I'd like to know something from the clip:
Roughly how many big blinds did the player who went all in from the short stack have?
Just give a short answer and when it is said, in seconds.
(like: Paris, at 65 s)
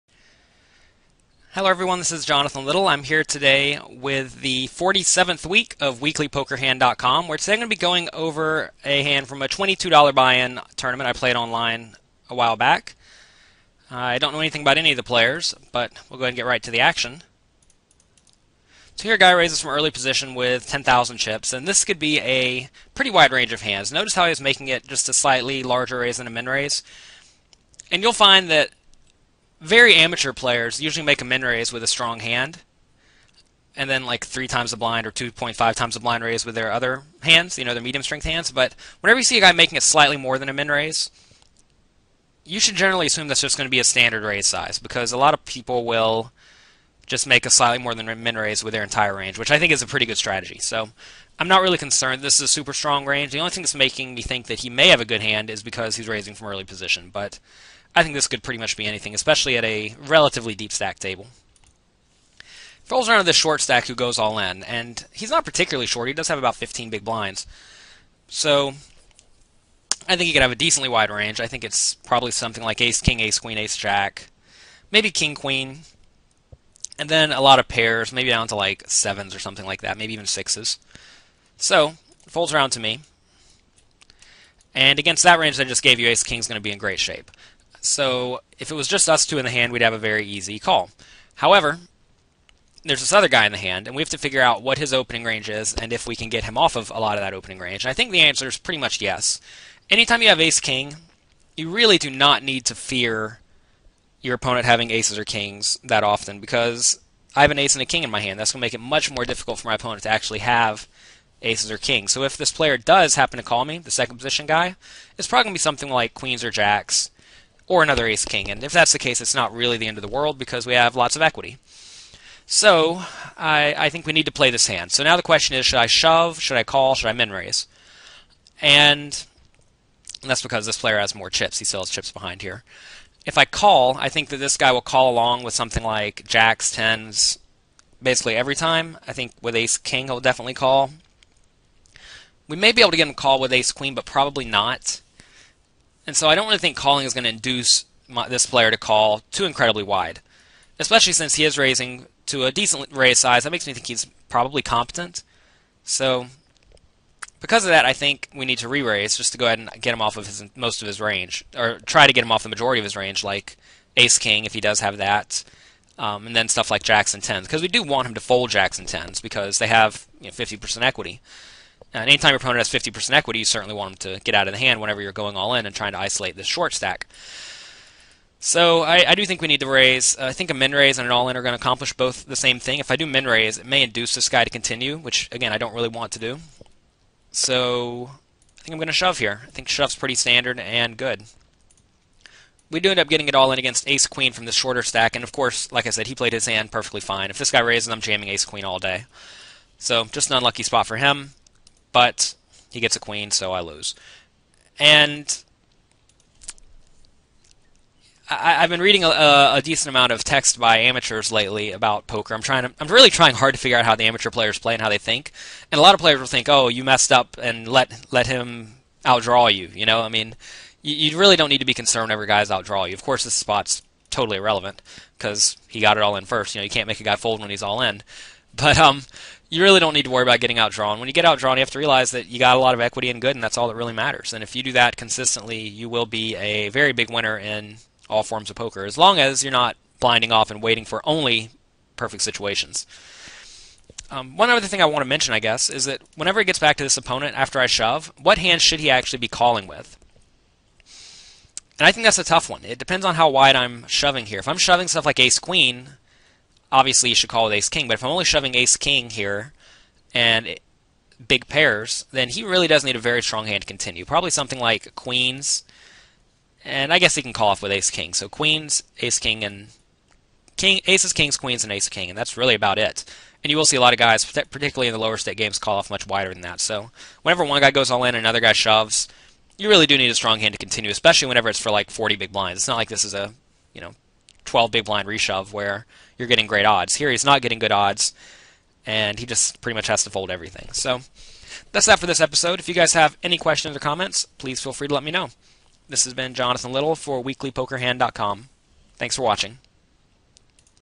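15, at 66 s.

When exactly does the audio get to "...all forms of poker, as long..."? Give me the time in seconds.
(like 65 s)
238 s.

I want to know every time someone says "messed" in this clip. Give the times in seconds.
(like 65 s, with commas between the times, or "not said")
216 s.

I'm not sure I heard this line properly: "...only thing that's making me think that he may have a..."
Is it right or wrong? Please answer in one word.
right.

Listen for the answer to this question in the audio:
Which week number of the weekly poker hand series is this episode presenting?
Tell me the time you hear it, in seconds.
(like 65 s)
4 s.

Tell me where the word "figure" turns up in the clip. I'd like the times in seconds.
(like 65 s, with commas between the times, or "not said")
94 s, 213 s.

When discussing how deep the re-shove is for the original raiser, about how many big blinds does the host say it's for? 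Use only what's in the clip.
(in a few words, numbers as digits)
40.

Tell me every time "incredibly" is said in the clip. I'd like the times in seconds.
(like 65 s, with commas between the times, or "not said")
149 s.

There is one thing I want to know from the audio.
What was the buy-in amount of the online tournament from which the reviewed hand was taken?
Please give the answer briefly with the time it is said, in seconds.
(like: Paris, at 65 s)
$22, at 9 s.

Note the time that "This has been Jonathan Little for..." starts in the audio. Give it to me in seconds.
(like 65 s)
295 s.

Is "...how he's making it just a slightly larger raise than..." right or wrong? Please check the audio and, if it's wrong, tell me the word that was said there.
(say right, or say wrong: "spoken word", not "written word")
right.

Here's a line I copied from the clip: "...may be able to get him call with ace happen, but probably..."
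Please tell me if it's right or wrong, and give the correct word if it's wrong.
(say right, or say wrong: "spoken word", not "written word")
wrong: "queen", not "happen".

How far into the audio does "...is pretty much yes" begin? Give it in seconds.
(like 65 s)
98 s.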